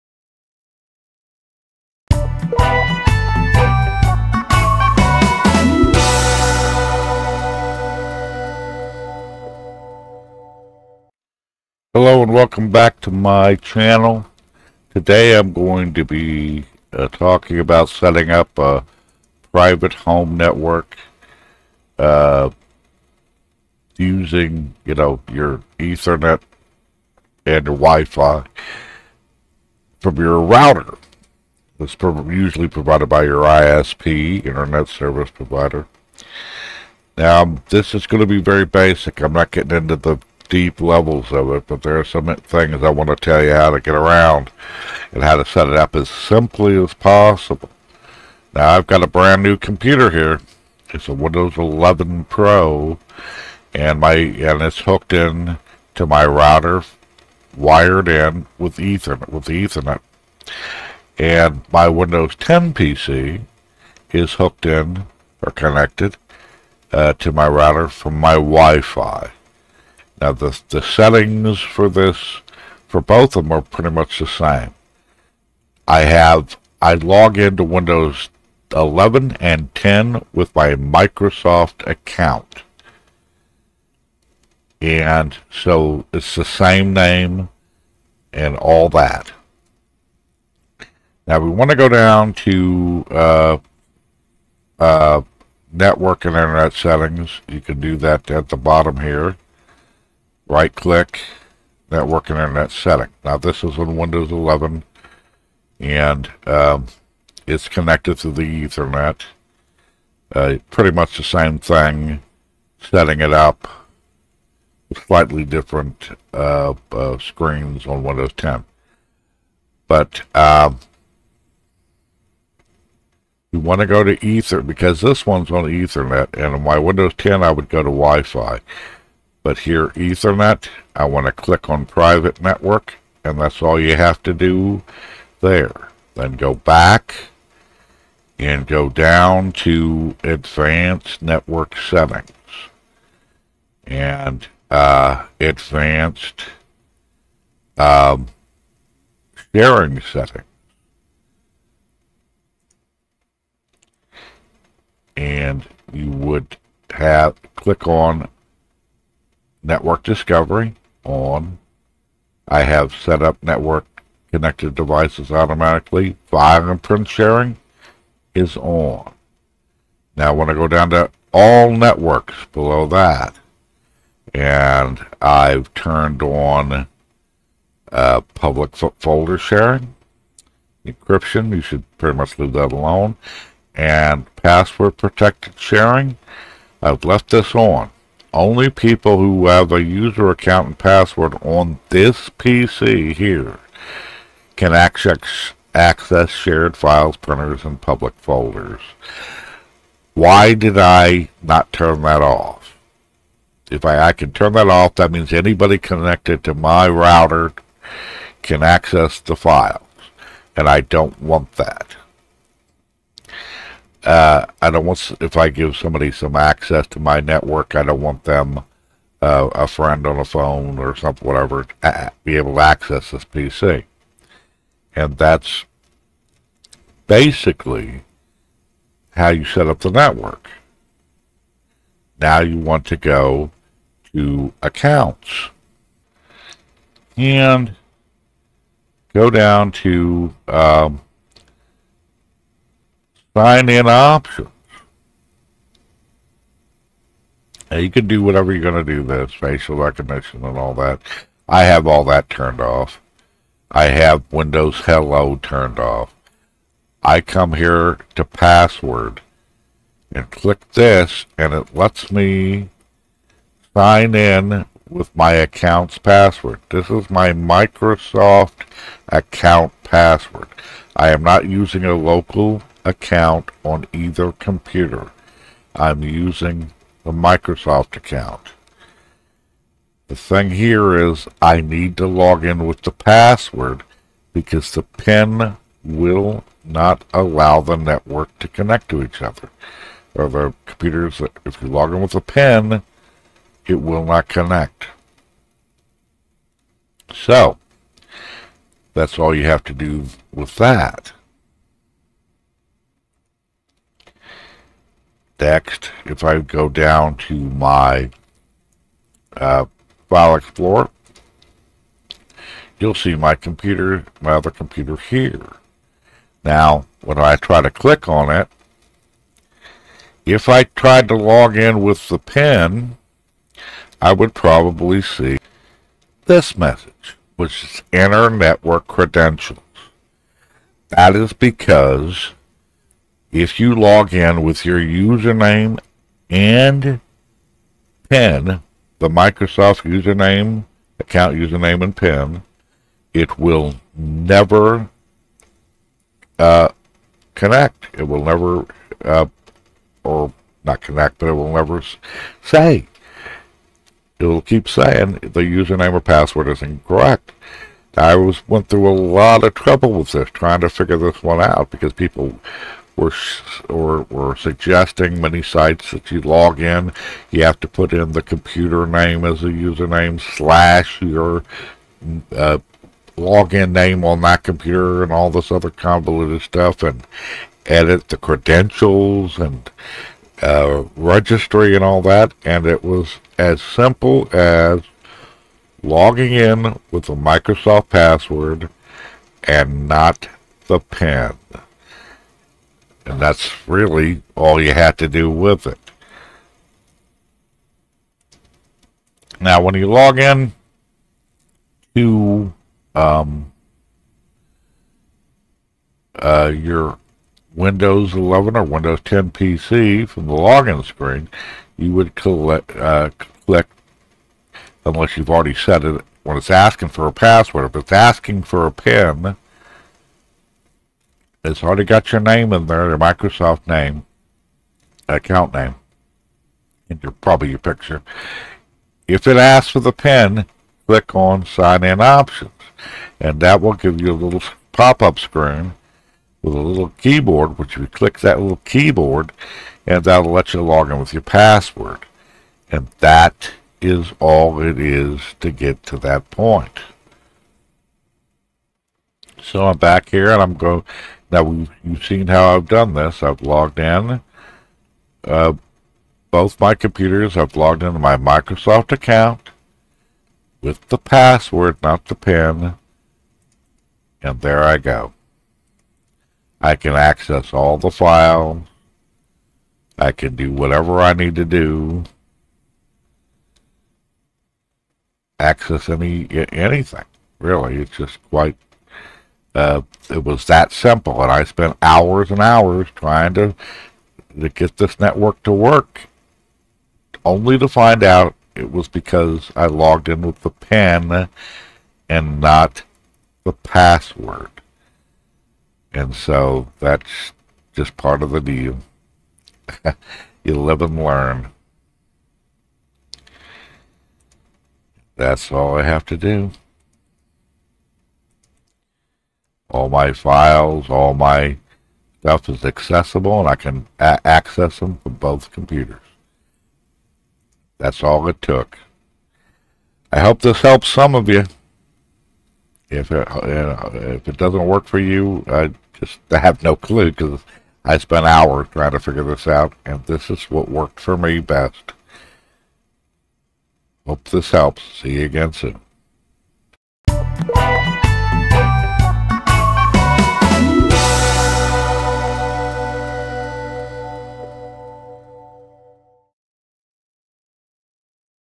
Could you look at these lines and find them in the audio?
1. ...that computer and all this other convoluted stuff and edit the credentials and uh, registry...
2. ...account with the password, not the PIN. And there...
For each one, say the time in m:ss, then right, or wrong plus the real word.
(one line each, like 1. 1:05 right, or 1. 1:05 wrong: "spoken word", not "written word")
1. 6:14 right
2. 7:38 right.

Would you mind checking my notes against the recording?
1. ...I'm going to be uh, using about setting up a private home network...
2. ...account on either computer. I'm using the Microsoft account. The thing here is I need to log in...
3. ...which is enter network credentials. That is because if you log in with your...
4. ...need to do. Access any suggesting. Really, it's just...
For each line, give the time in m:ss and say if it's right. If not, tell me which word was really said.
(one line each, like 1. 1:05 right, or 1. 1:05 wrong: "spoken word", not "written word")
1. 0:15 wrong: "talking", not "using"
2. 4:32 right
3. 5:27 right
4. 7:51 wrong: "anything", not "suggesting".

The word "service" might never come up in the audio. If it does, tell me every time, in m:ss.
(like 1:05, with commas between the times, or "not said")
0:34.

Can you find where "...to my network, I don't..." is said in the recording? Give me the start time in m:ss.
3:36.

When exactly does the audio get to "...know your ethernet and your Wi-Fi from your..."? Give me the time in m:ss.
0:24.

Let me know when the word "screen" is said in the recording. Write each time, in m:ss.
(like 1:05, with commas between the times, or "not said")
1:57, 6:50, 7:15.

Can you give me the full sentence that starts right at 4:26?
This is my Microsoft account password.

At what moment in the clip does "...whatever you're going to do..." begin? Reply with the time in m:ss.
4:08.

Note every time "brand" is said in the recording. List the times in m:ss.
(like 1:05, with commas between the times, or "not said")
0:49.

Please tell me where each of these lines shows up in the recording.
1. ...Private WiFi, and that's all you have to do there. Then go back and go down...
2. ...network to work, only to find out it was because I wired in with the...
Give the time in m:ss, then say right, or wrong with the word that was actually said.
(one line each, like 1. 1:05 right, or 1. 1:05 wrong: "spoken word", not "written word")
1. 2:11 wrong: "Network", not "WiFi"
2. 8:04 wrong: "logged", not "wired".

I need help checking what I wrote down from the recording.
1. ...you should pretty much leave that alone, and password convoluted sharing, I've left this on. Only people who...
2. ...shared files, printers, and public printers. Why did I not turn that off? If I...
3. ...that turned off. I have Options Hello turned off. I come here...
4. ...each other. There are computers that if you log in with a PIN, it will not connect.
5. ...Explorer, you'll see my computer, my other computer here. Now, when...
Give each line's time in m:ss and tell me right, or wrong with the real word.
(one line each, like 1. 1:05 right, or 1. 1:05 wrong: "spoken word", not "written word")
1. 3:01 wrong: "protected", not "convoluted"
2. 3:16 wrong: "folders", not "printers"
3. 4:12 wrong: "Windows", not "Options"
4. 4:49 right
5. 5:10 right.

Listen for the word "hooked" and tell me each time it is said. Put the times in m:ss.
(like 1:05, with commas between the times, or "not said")
0:54, 1:04.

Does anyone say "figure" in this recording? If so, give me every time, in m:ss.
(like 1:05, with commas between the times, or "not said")
6:00, 8:48.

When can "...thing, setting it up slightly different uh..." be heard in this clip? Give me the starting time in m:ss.
1:51.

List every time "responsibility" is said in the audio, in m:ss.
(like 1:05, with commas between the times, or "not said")
not said.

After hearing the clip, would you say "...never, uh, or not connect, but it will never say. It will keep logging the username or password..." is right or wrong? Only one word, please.
wrong.